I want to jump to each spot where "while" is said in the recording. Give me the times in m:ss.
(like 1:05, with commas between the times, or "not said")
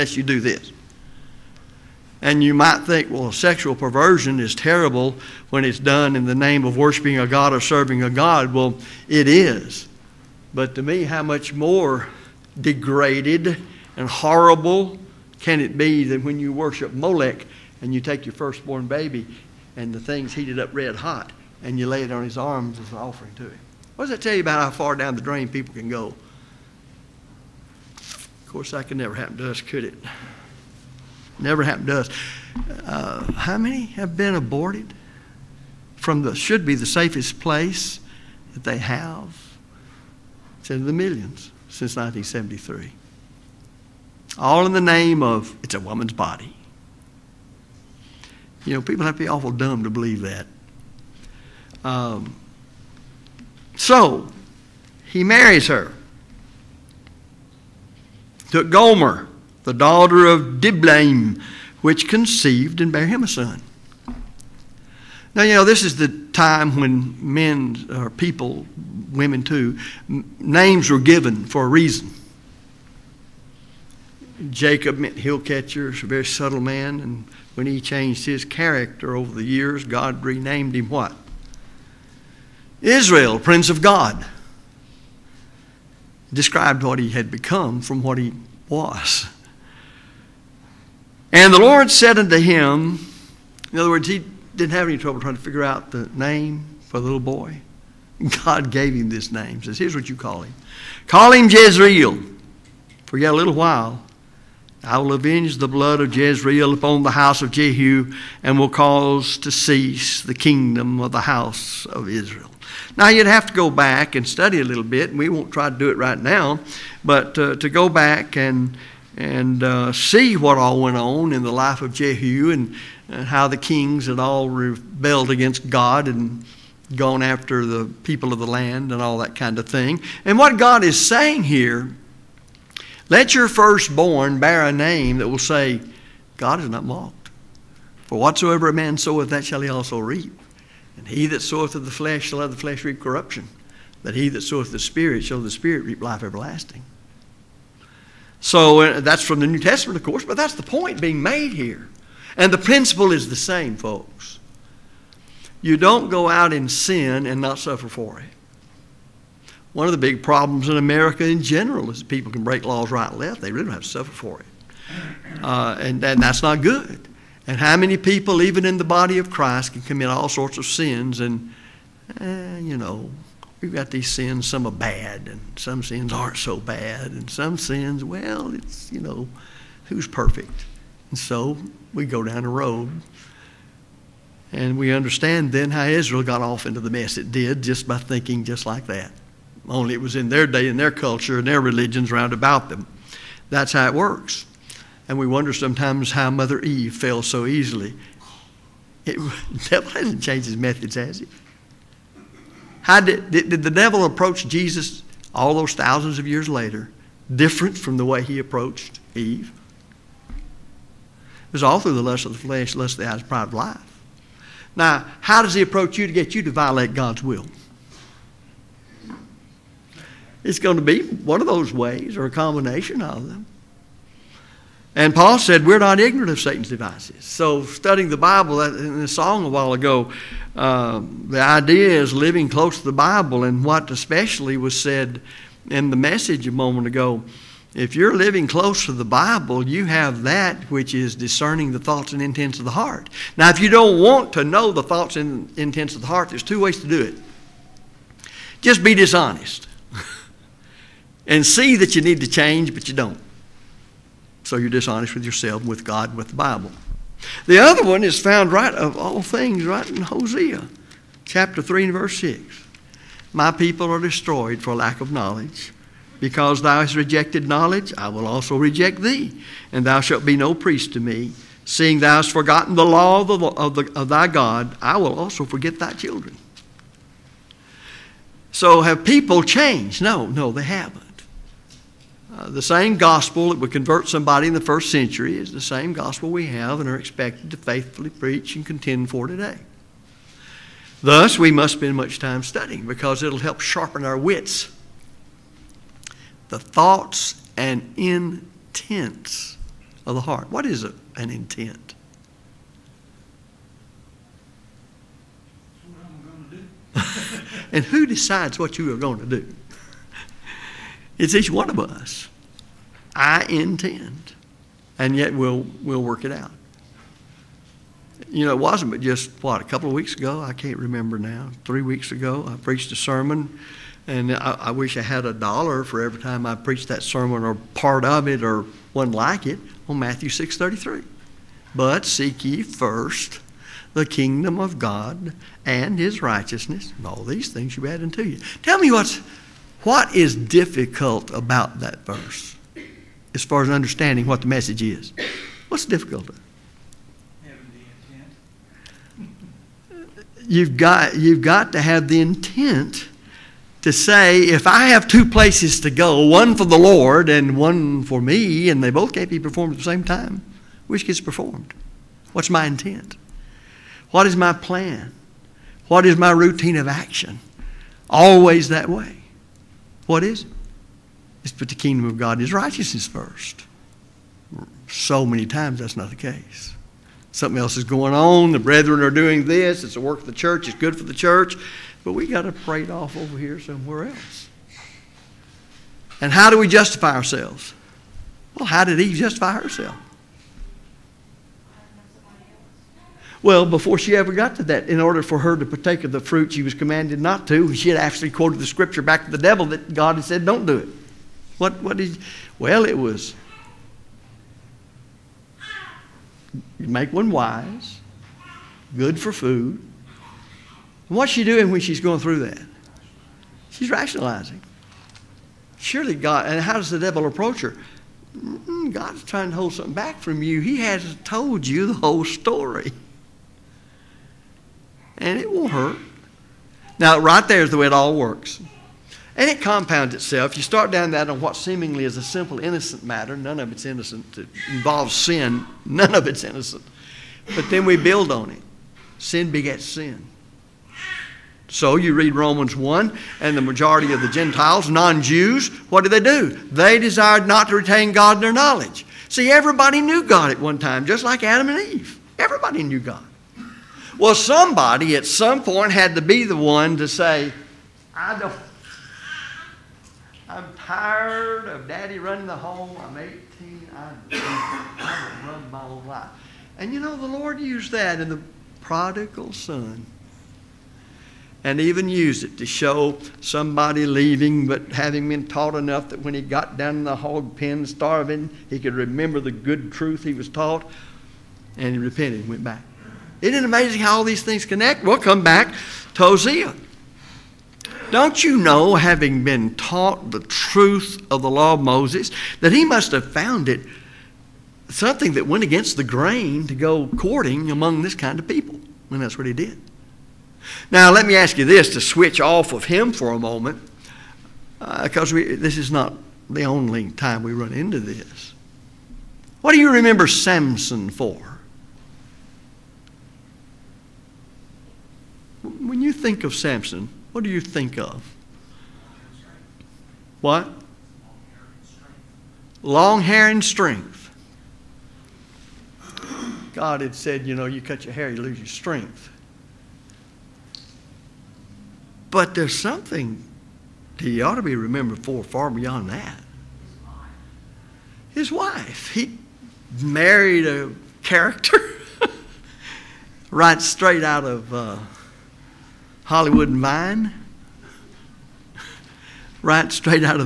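1:43, 3:49.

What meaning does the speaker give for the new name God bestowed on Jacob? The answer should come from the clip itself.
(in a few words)
Prince of God.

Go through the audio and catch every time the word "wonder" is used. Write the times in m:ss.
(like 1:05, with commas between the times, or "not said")
3:15.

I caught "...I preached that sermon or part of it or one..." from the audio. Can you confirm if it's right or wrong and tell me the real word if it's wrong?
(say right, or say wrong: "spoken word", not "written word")
right.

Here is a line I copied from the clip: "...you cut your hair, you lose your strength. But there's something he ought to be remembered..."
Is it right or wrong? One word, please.
right.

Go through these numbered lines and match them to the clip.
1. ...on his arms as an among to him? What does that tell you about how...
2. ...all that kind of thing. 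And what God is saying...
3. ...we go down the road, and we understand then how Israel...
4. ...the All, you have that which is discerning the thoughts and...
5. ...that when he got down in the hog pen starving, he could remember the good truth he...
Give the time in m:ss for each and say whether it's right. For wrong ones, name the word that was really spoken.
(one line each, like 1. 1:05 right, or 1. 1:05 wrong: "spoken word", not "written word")
1. 0:22 wrong: "offering", not "among"
2. 2:09 right
3. 3:01 right
4. 3:58 wrong: "Bible", not "All"
5. 7:56 right.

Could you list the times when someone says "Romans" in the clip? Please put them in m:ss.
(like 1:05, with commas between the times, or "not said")
7:22.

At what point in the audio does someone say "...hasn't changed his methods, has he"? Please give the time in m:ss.
3:19.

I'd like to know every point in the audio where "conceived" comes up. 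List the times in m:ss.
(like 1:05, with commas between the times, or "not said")
1:02.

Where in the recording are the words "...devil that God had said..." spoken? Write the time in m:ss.
6:39.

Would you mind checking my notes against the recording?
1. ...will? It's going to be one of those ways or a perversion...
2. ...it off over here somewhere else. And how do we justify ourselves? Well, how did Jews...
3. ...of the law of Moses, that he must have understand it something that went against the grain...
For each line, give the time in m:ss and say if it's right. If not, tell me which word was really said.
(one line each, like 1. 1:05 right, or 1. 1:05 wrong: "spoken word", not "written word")
1. 3:37 wrong: "combination", not "perversion"
2. 6:22 wrong: "Eve", not "Jews"
3. 8:11 wrong: "found", not "understand".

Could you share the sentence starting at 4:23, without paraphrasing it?
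My people are destroyed for lack of knowledge.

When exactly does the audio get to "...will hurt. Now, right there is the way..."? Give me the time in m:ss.
7:05.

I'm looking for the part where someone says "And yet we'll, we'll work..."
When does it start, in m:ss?
5:14.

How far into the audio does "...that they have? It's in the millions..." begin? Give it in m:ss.
0:38.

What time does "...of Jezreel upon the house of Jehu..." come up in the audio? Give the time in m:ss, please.
1:45.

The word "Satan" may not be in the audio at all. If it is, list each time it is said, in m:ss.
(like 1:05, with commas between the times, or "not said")
3:46.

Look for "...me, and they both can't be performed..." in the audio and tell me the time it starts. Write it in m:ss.
5:58.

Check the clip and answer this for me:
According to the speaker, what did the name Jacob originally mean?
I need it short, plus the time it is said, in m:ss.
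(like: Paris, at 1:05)
Hill catcher, at 1:15.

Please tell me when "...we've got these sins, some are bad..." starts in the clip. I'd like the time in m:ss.
2:53.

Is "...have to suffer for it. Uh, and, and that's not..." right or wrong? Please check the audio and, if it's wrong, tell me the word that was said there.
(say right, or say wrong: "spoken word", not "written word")
right.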